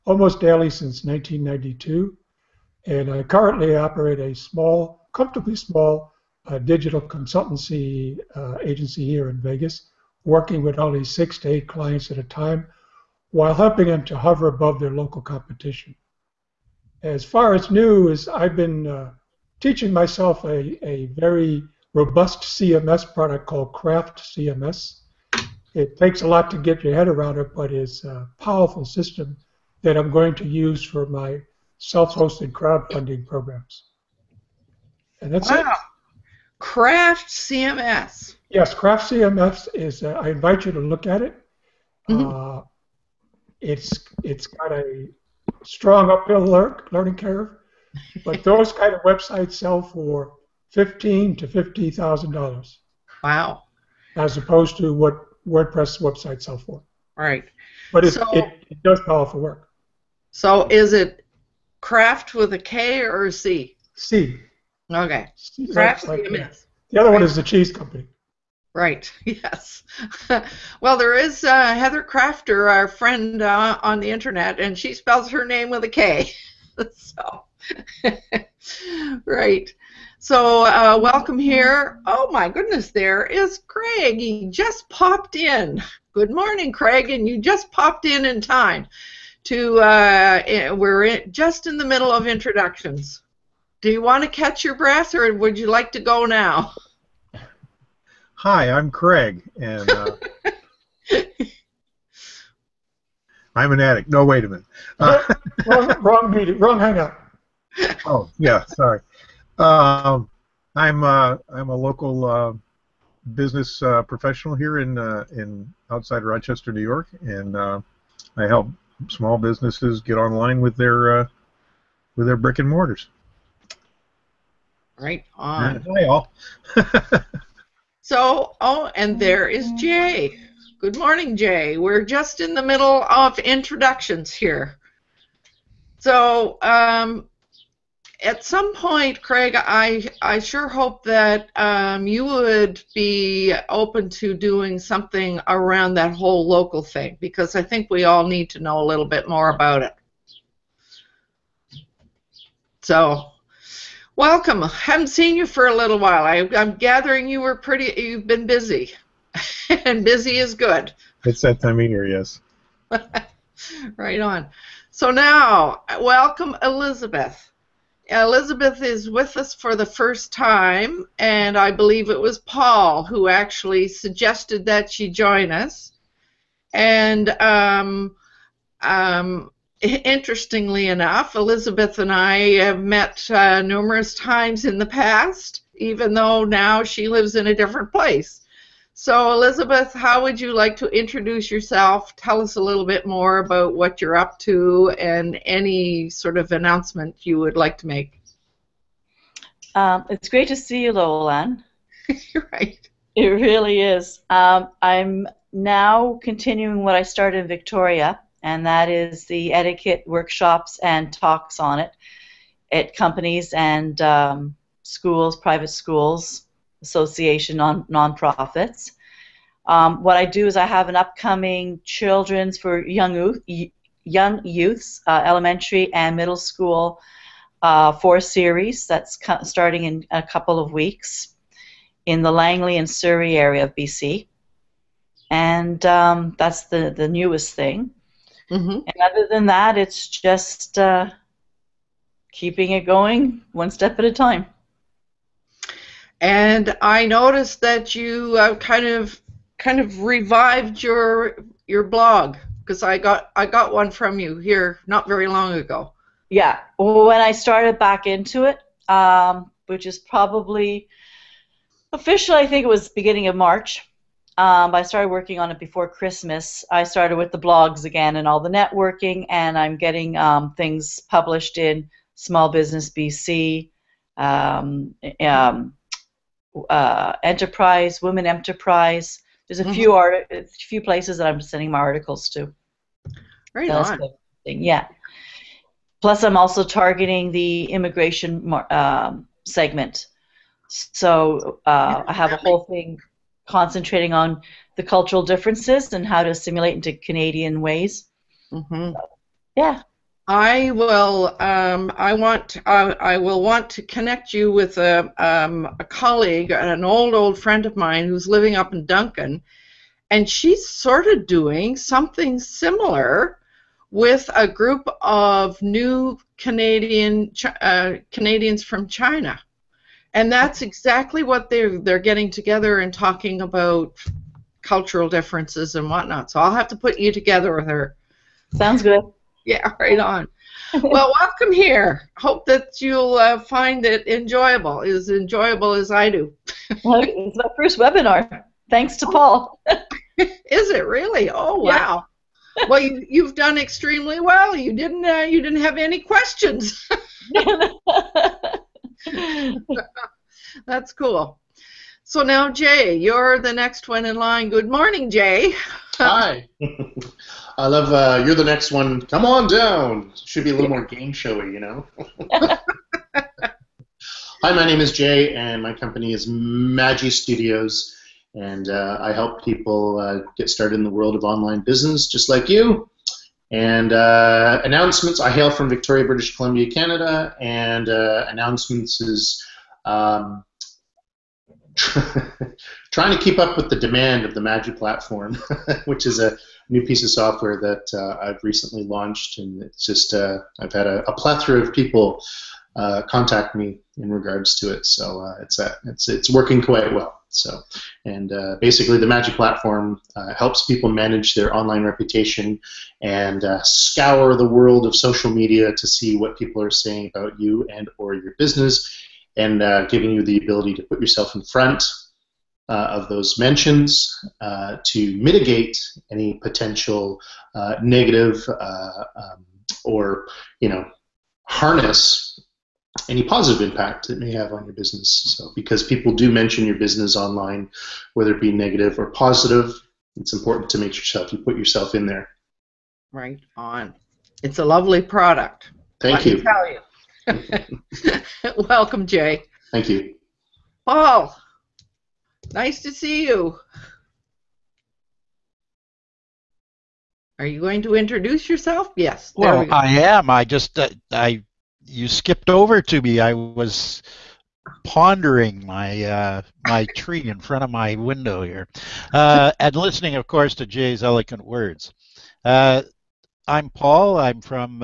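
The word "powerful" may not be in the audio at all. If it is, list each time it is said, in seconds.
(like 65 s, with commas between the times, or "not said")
28 s, 59 s.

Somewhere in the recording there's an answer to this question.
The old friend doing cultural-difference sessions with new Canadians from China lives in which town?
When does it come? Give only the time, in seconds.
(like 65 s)
308 s.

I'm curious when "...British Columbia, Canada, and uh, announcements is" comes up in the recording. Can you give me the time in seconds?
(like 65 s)
376 s.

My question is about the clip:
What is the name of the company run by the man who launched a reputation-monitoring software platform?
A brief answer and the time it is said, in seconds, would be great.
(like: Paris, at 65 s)
Magi Studios, at 366 s.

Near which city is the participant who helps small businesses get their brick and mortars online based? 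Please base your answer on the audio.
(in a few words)
Rochester, New York.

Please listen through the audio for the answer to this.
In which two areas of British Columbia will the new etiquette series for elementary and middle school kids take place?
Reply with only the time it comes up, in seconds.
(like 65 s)
232 s.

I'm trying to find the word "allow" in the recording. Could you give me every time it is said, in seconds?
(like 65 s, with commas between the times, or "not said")
not said.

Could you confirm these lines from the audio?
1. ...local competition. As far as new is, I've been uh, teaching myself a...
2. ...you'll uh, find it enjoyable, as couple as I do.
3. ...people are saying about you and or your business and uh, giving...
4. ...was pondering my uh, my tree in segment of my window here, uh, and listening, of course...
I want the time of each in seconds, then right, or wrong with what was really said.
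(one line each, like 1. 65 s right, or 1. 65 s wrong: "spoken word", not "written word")
1. 14 s right
2. 332 s wrong: "enjoyable", not "couple"
3. 406 s right
4. 453 s wrong: "front", not "segment".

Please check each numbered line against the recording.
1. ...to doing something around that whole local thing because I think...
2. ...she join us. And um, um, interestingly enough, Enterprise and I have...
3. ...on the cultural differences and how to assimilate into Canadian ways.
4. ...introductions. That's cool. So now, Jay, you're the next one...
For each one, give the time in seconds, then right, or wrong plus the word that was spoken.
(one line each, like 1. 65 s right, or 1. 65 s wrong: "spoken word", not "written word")
1. 144 s right
2. 174 s wrong: "Elizabeth", not "Enterprise"
3. 294 s right
4. 345 s wrong: "questions", not "introductions".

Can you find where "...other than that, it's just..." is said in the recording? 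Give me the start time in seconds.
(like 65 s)
239 s.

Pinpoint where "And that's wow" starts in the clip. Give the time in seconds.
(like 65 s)
35 s.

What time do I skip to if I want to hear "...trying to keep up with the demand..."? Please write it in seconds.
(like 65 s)
382 s.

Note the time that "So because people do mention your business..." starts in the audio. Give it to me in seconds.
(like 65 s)
425 s.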